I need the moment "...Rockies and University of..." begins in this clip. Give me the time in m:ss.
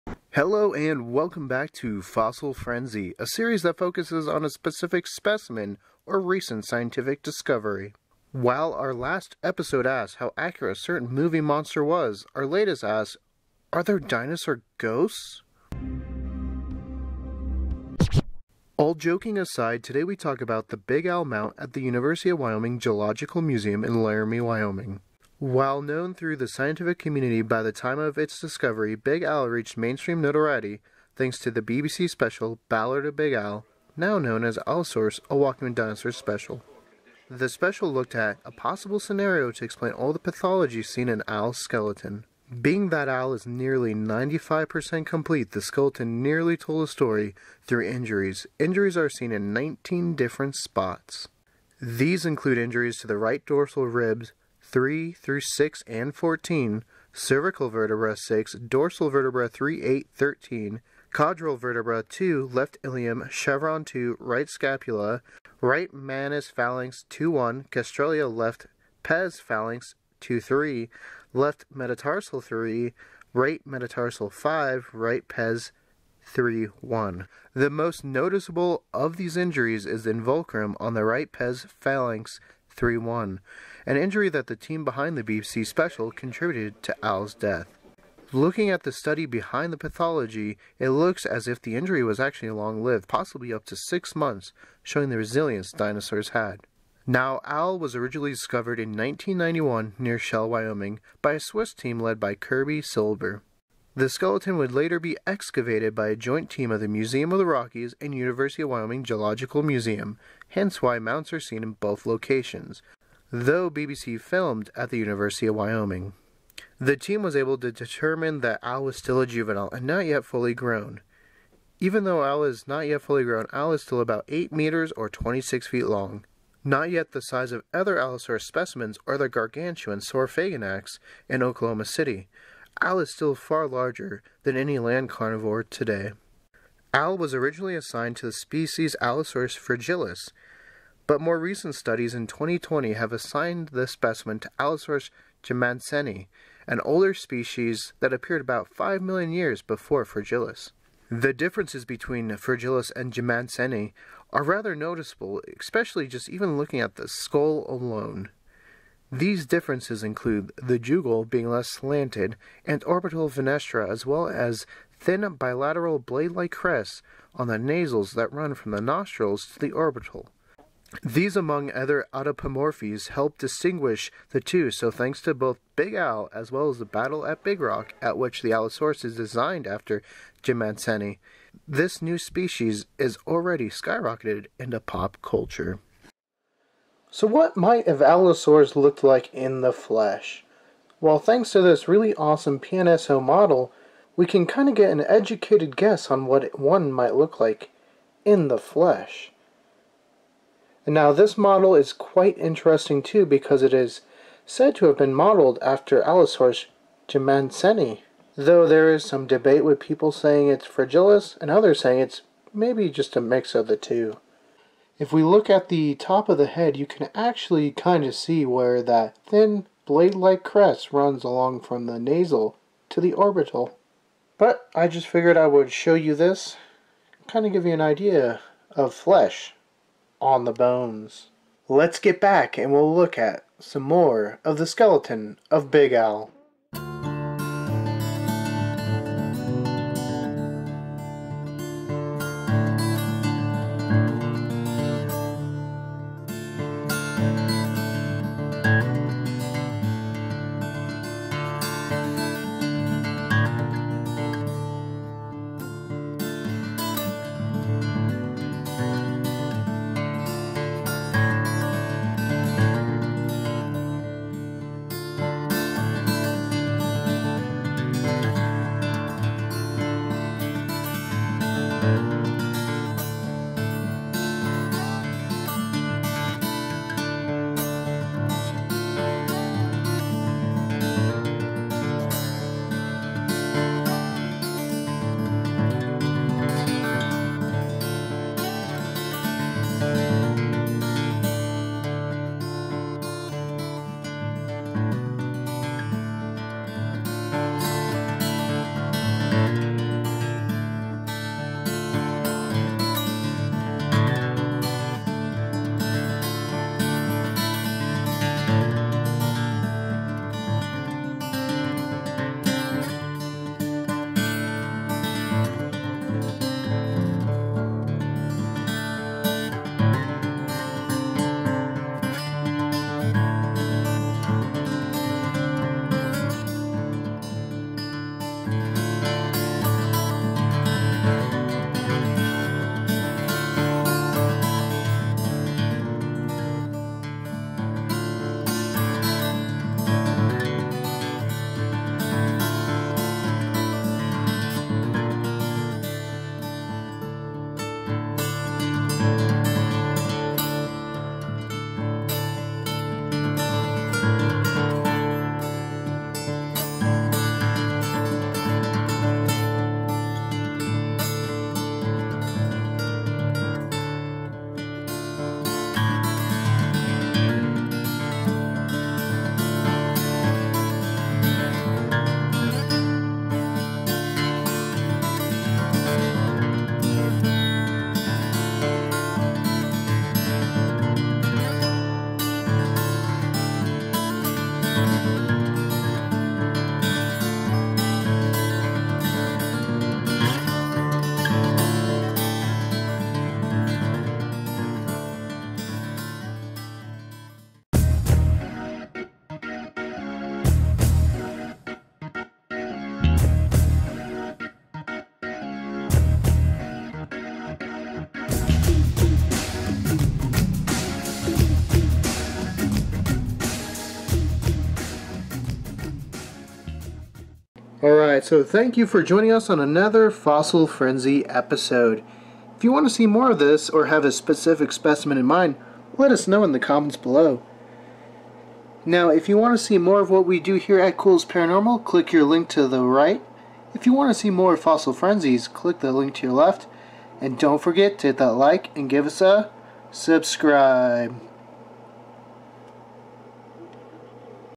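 1:47.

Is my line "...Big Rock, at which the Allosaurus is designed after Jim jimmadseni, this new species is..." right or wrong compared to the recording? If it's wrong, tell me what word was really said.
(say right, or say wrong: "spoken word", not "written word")
right.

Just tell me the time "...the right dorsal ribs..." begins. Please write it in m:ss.
0:53.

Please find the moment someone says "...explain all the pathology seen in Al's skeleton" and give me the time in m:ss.
0:39.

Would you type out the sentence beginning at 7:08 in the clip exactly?
Now, if you want to see more of what we do here at Culz Paranormal, click your link to the right.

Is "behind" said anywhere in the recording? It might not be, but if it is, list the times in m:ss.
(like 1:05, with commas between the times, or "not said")
1:24, 1:29.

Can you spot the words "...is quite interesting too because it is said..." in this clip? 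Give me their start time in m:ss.
3:21.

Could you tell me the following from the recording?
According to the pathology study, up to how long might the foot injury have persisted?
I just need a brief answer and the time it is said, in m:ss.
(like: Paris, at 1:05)
6 months, at 1:33.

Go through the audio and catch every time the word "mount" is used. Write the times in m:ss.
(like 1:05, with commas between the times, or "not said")
0:21, 1:50.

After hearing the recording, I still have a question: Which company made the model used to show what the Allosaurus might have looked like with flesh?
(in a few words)
PNSO.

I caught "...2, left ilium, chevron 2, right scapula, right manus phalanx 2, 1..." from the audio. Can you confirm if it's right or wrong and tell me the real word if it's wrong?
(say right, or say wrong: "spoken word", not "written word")
right.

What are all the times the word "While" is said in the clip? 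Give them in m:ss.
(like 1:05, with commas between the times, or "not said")
0:08, 0:25.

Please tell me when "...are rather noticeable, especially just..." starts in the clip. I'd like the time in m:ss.
2:34.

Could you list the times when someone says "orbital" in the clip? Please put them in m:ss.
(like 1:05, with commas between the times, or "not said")
2:42, 2:49, 3:43.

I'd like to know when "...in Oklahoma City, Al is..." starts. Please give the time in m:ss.
2:11.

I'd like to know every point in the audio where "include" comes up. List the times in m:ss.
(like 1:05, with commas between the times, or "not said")
0:52, 2:40.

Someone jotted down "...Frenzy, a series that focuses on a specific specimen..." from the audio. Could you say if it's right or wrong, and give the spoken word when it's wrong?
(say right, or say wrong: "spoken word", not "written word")
right.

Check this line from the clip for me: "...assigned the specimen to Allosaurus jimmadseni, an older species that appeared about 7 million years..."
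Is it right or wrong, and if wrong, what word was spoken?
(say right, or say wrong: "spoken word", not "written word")
wrong: "5", not "7".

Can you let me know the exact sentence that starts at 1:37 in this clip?
Now, Al was originally discovered in 1991 near Shell, Wyoming, by a Swiss team led by Kirby Siber.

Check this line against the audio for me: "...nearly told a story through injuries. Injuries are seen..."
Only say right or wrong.
right.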